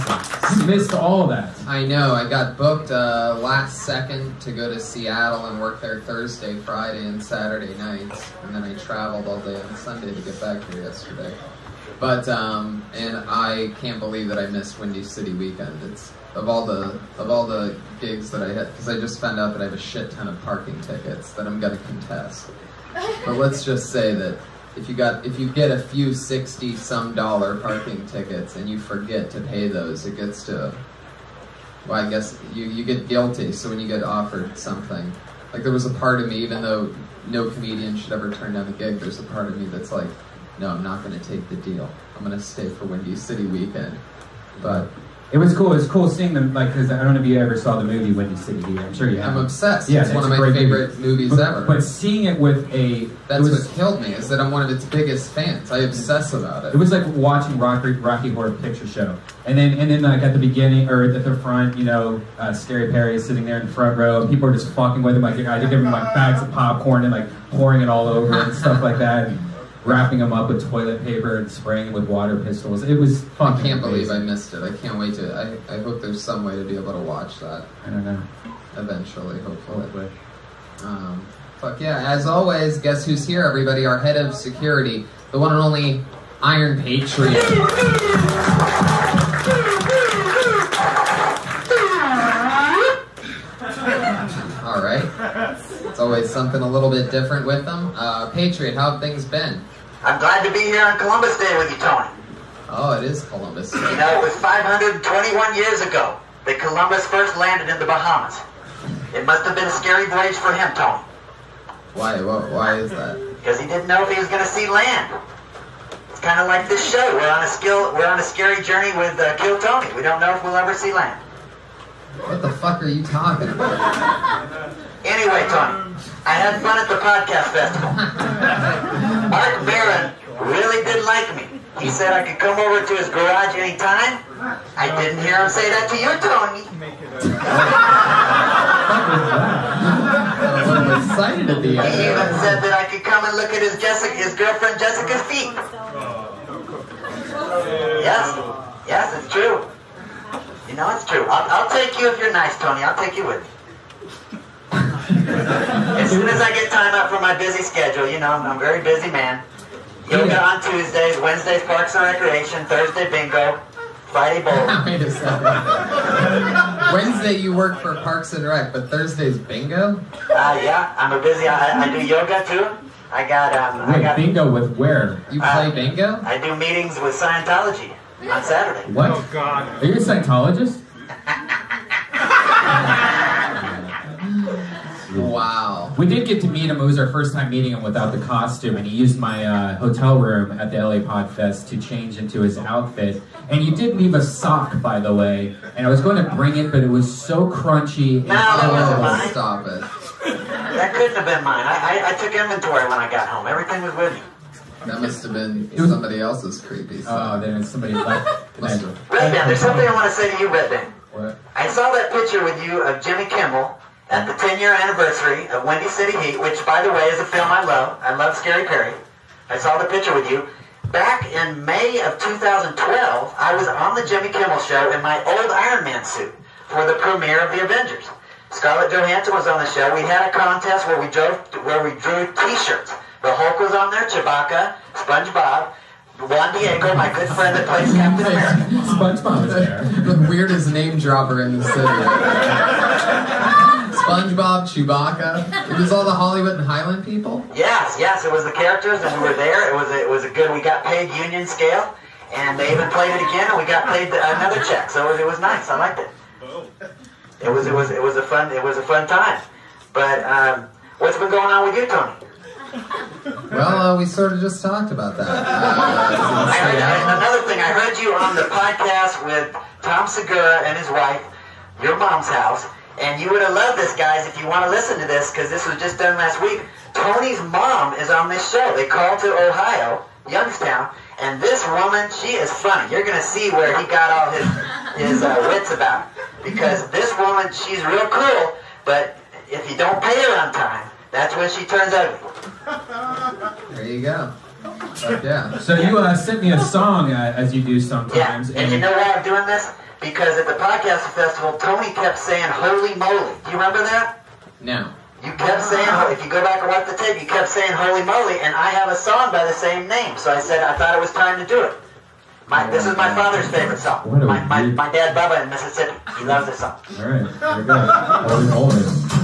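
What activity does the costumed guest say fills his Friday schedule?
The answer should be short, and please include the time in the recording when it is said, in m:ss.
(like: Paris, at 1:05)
Bowl, at 2:44.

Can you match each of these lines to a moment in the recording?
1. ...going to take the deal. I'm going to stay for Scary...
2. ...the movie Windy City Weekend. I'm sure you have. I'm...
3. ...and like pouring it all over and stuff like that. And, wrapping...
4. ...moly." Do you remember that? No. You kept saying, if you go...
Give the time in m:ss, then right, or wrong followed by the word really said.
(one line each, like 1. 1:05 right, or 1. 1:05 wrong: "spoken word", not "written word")
1. 0:41 wrong: "Windy", not "Scary"
2. 0:47 right
3. 1:07 right
4. 5:02 right.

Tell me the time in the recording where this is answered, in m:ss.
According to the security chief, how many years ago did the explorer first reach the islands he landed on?
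1:44.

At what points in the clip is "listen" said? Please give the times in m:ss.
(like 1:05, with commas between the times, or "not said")
4:34.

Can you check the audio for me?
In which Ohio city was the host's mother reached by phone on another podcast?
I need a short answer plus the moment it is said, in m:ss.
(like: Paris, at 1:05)
Youngstown, at 4:40.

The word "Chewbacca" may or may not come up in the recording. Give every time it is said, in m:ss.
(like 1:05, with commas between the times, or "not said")
3:54, 4:04.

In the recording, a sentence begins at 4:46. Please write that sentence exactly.
Because this woman, she's real cool, but if you don't pay her on time, that's when she turns ugly.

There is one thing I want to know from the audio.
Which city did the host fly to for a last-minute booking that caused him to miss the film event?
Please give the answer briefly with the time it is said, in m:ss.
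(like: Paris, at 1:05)
Seattle, at 0:04.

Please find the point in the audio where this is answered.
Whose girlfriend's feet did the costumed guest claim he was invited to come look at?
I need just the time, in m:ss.
2:09.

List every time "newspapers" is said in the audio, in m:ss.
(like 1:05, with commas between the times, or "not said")
not said.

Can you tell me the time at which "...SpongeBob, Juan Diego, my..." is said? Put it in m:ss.
3:54.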